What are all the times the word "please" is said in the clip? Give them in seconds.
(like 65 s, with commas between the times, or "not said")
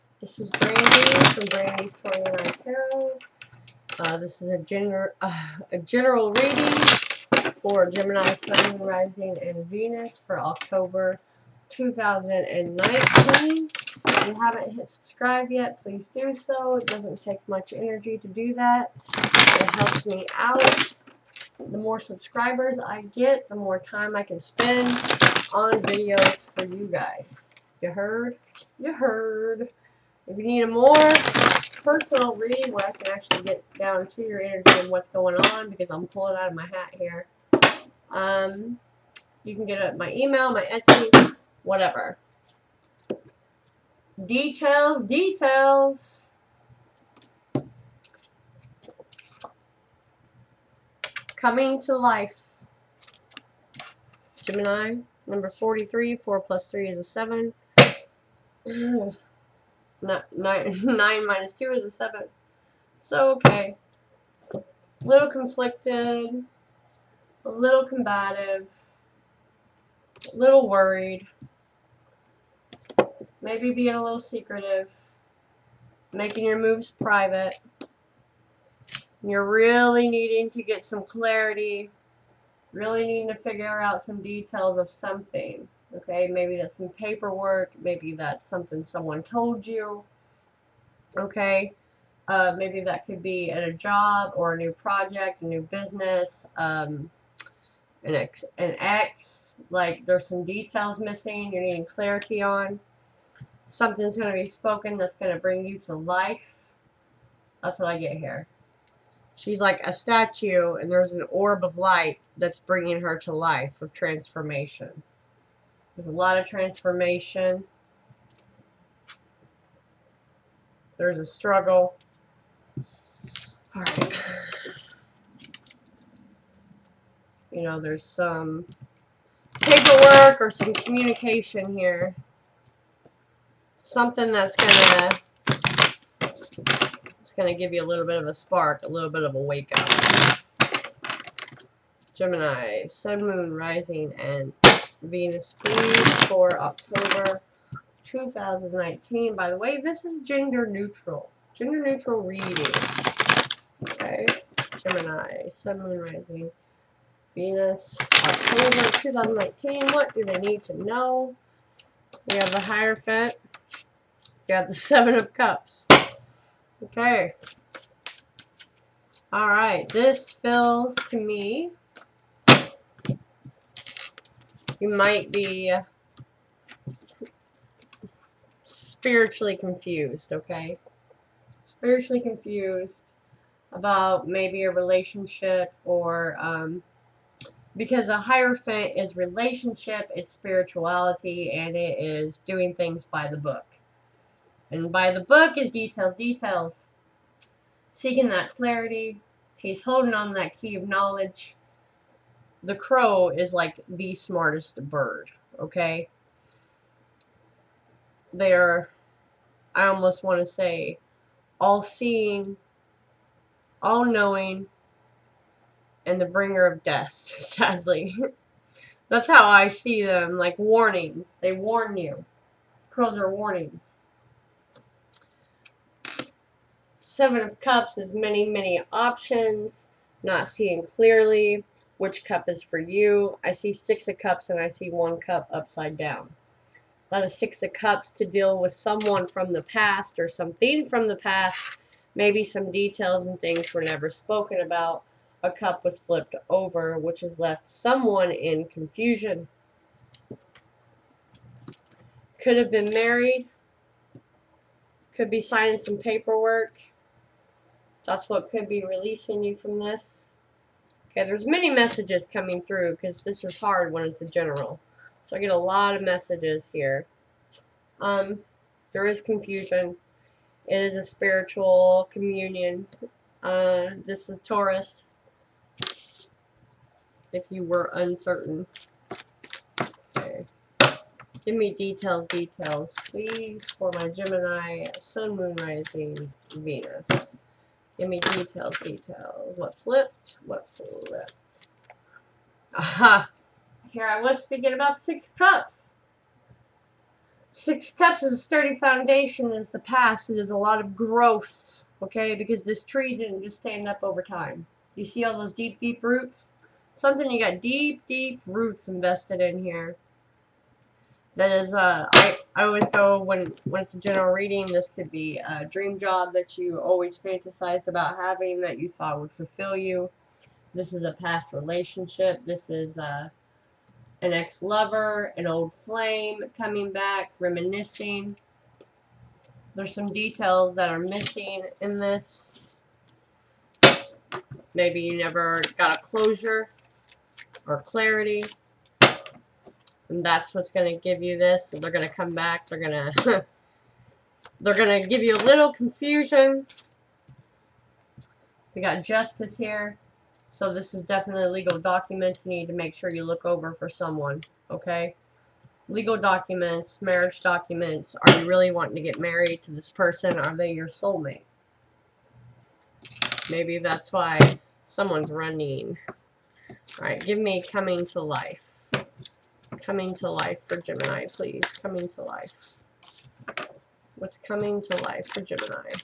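15 s, 145 s, 283 s, 371 s.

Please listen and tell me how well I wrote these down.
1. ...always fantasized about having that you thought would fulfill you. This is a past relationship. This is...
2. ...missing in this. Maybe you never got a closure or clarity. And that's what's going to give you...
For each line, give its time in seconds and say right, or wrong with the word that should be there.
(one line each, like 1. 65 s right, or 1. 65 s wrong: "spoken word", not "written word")
1. 316 s right
2. 330 s right.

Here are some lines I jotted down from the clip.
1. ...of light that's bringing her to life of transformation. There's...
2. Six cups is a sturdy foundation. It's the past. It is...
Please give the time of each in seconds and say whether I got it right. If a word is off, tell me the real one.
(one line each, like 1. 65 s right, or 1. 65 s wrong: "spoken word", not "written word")
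1. 111 s right
2. 297 s right.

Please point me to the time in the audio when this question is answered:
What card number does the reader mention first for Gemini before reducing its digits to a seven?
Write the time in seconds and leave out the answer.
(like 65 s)
55 s.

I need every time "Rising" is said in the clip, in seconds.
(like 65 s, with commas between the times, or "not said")
8 s, 143 s, 155 s, 285 s.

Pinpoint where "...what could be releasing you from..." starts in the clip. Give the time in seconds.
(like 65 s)
258 s.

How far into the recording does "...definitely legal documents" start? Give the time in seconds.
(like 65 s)
351 s.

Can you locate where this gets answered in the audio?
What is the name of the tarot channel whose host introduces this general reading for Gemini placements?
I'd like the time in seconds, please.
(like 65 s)
1 s.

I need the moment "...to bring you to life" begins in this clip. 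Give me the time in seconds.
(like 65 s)
105 s.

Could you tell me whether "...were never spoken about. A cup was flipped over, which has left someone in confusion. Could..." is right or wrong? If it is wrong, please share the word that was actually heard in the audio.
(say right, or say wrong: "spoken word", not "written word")
right.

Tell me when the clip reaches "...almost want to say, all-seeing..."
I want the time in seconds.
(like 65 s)
209 s.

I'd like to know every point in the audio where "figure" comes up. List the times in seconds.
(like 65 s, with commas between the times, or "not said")
83 s.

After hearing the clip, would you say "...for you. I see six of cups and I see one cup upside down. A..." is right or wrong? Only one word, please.
right.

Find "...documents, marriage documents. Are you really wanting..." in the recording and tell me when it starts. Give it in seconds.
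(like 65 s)
356 s.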